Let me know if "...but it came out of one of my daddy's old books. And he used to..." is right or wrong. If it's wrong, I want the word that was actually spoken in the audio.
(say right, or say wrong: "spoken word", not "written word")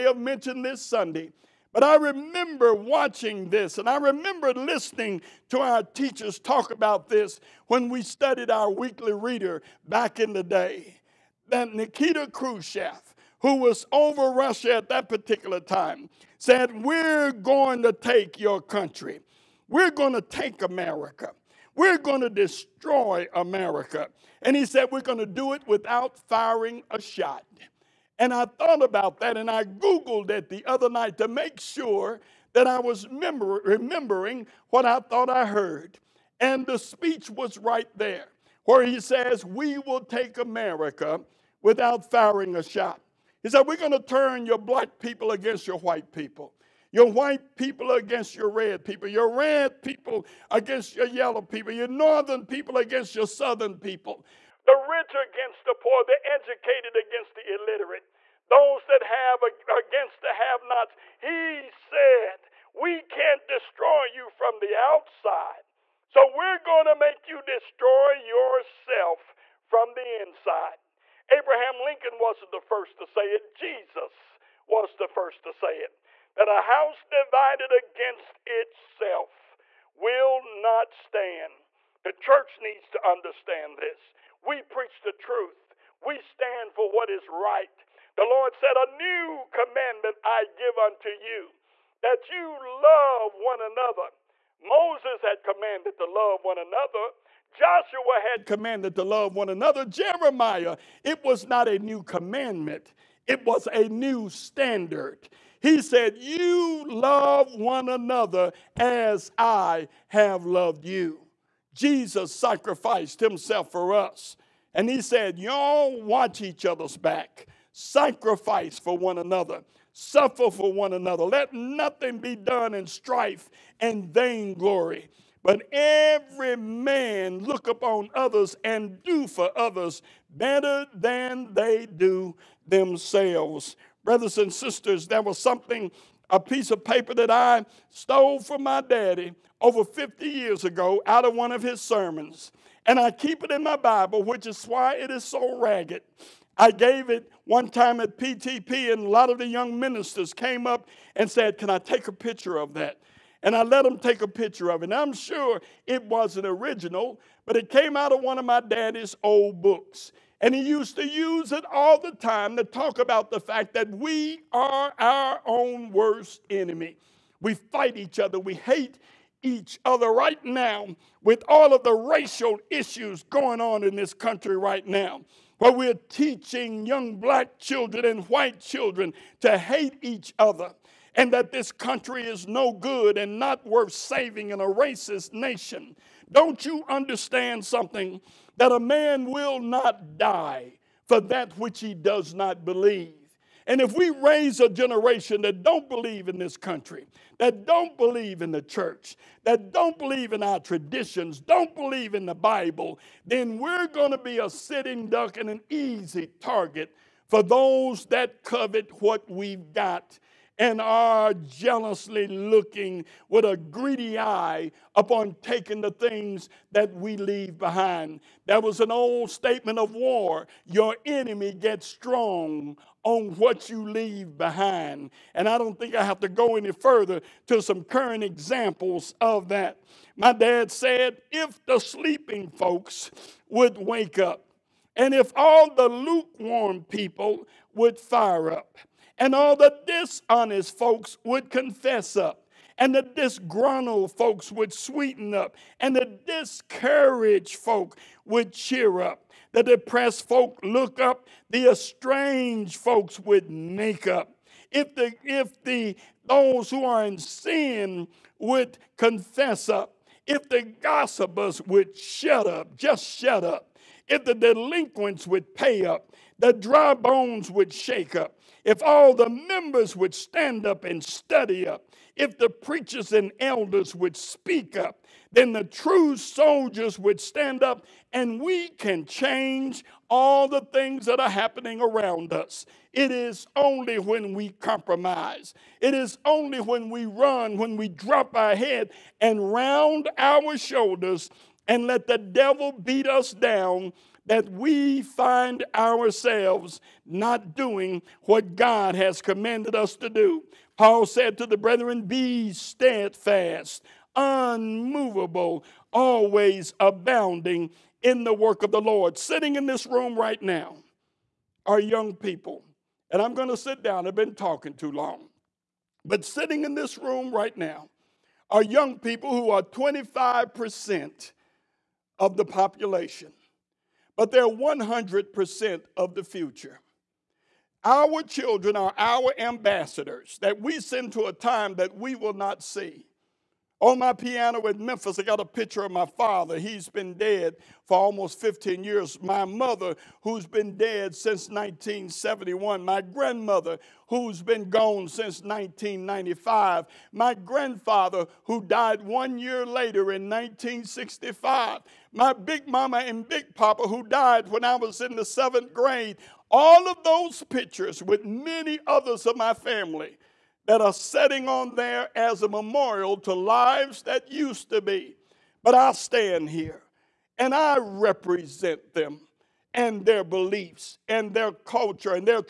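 right.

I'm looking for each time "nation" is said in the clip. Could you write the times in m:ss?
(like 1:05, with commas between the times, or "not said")
3:05.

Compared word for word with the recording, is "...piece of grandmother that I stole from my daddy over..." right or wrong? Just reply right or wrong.
wrong.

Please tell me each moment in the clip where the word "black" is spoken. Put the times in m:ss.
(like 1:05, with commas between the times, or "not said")
0:44, 2:57.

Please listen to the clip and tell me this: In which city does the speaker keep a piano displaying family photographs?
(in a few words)
Memphis.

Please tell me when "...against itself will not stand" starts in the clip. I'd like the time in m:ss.
1:17.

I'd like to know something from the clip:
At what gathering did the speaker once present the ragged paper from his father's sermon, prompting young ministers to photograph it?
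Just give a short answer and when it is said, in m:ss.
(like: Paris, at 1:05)
PTP, at 2:28.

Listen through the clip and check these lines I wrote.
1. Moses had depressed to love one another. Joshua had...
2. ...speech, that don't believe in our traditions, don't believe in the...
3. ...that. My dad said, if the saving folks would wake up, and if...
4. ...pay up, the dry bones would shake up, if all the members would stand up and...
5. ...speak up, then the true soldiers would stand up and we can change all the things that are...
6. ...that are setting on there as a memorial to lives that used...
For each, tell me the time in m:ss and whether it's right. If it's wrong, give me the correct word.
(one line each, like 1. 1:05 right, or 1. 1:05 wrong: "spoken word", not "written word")
1. 1:34 wrong: "commanded", not "depressed"
2. 3:18 wrong: "church", not "speech"
3. 3:49 wrong: "sleeping", not "saving"
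4. 4:25 right
5. 4:34 right
6. 6:00 right.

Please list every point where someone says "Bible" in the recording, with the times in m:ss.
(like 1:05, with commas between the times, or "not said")
2:23, 3:22.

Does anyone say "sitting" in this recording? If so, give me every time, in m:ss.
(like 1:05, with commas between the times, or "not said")
3:24, 5:09, 5:16.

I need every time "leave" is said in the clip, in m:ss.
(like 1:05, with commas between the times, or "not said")
3:37, 3:43.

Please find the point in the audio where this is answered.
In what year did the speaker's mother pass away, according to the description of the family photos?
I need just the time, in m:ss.
5:41.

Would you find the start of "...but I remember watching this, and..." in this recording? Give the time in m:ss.
0:01.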